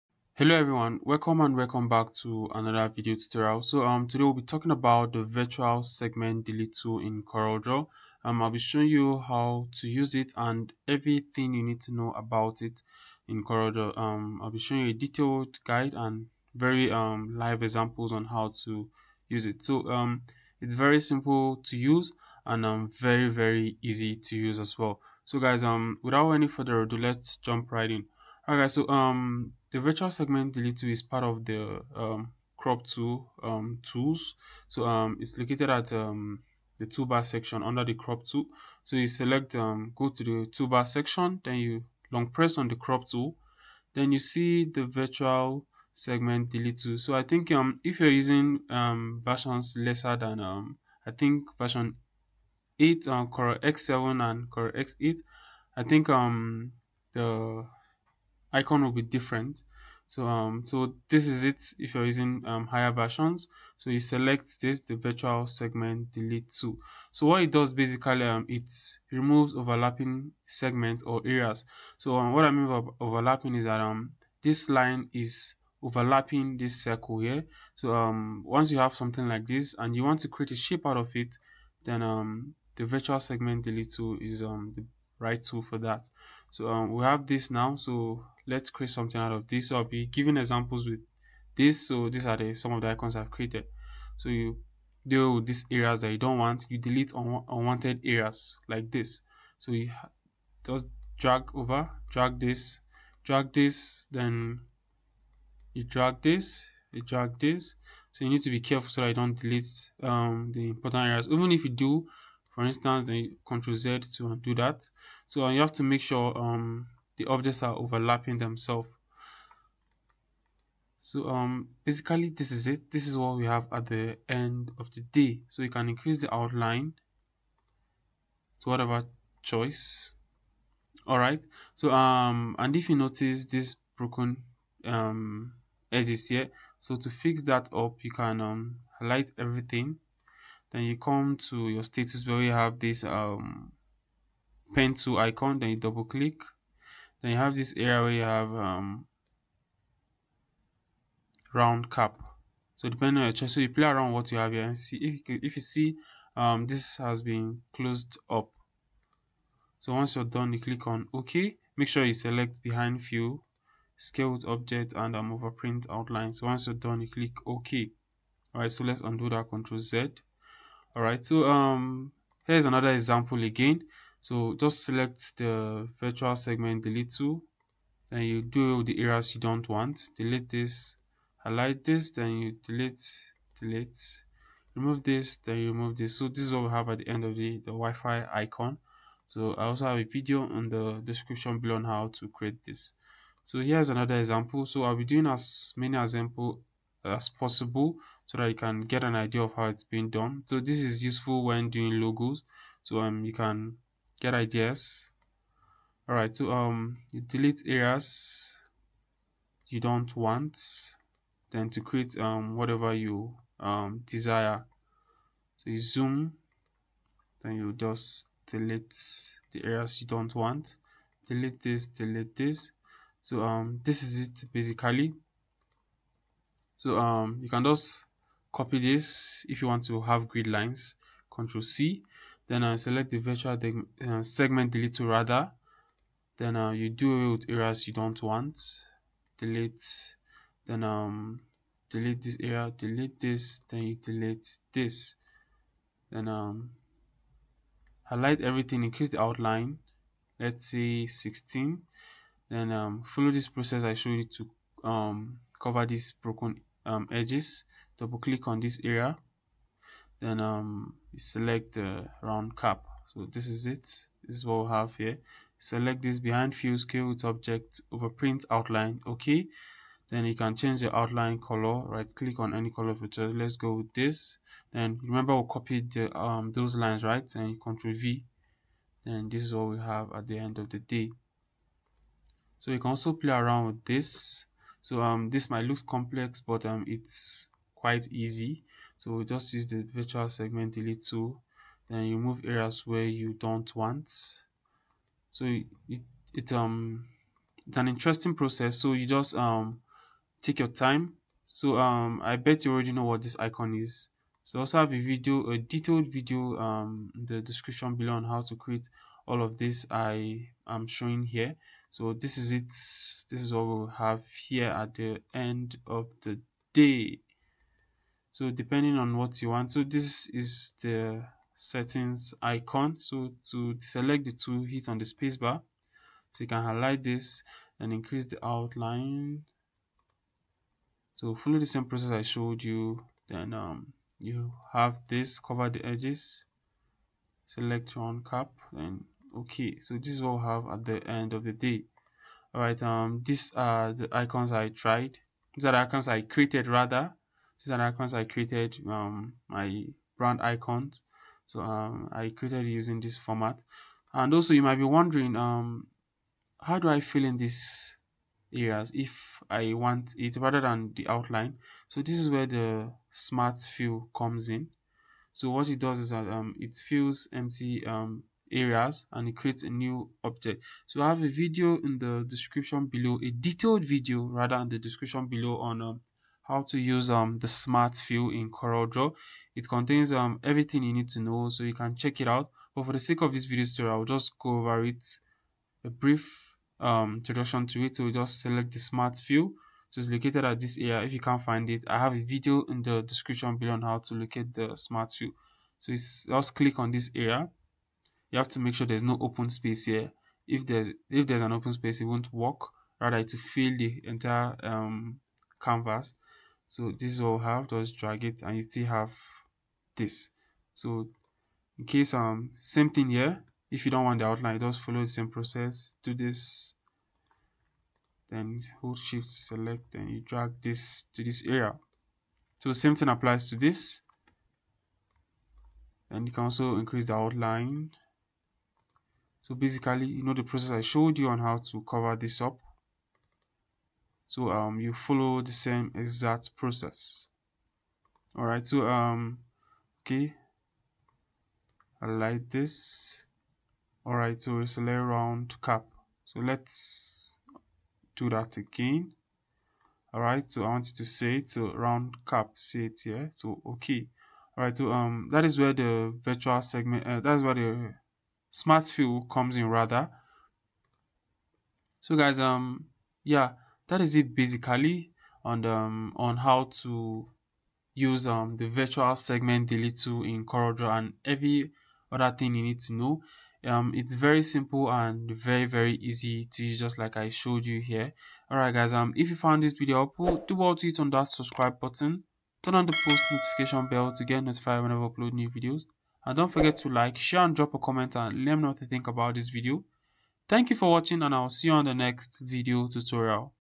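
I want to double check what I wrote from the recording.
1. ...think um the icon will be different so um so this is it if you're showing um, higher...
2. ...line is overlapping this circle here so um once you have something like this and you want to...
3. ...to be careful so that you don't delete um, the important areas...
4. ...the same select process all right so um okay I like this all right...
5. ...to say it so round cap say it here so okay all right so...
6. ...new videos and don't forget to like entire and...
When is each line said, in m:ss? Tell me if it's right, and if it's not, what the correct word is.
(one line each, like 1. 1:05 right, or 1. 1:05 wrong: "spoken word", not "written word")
1. 0:55 wrong: "using", not "showing"
2. 1:14 right
3. 1:48 right
4. 7:15 wrong: "exact", not "select"
5. 7:30 right
6. 8:05 wrong: "share", not "entire".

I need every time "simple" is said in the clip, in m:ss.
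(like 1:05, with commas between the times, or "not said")
0:21, 7:54.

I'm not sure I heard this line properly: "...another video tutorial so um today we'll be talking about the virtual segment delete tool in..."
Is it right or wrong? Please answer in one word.
right.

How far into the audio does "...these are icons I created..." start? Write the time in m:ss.
5:47.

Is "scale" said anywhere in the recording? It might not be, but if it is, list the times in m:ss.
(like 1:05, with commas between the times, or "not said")
2:43, 4:26.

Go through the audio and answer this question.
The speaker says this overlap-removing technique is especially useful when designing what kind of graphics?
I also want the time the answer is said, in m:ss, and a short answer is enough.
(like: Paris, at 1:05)
Logos, at 3:21.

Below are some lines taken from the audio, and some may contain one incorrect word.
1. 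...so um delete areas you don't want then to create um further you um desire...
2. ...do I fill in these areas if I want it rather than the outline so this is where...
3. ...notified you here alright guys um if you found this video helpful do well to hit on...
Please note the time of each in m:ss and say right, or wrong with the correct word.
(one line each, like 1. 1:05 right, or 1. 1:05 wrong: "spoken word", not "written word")
1. 3:26 wrong: "whatever", not "further"
2. 5:56 right
3. 7:57 wrong: "showed", not "notified".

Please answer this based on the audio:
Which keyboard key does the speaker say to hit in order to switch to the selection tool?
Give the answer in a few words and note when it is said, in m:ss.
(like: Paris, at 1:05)
Spacebar, at 5:25.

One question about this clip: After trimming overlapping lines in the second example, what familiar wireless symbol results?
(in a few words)
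Wi-Fi icon.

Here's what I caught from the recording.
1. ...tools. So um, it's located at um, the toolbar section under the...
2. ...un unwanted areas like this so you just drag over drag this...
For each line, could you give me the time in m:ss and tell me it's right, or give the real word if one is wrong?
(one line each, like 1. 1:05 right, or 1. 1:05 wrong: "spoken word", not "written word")
1. 0:33 right
2. 1:37 right.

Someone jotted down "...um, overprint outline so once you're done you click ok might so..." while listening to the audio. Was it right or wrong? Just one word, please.
wrong.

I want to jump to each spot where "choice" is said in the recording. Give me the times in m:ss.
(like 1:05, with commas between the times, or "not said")
2:09, 2:33.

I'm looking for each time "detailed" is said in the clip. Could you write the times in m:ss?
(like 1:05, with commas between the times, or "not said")
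0:14, 5:05, 6:13.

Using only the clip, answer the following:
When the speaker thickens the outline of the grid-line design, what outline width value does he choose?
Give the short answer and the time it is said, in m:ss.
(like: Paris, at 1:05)
16, at 4:11.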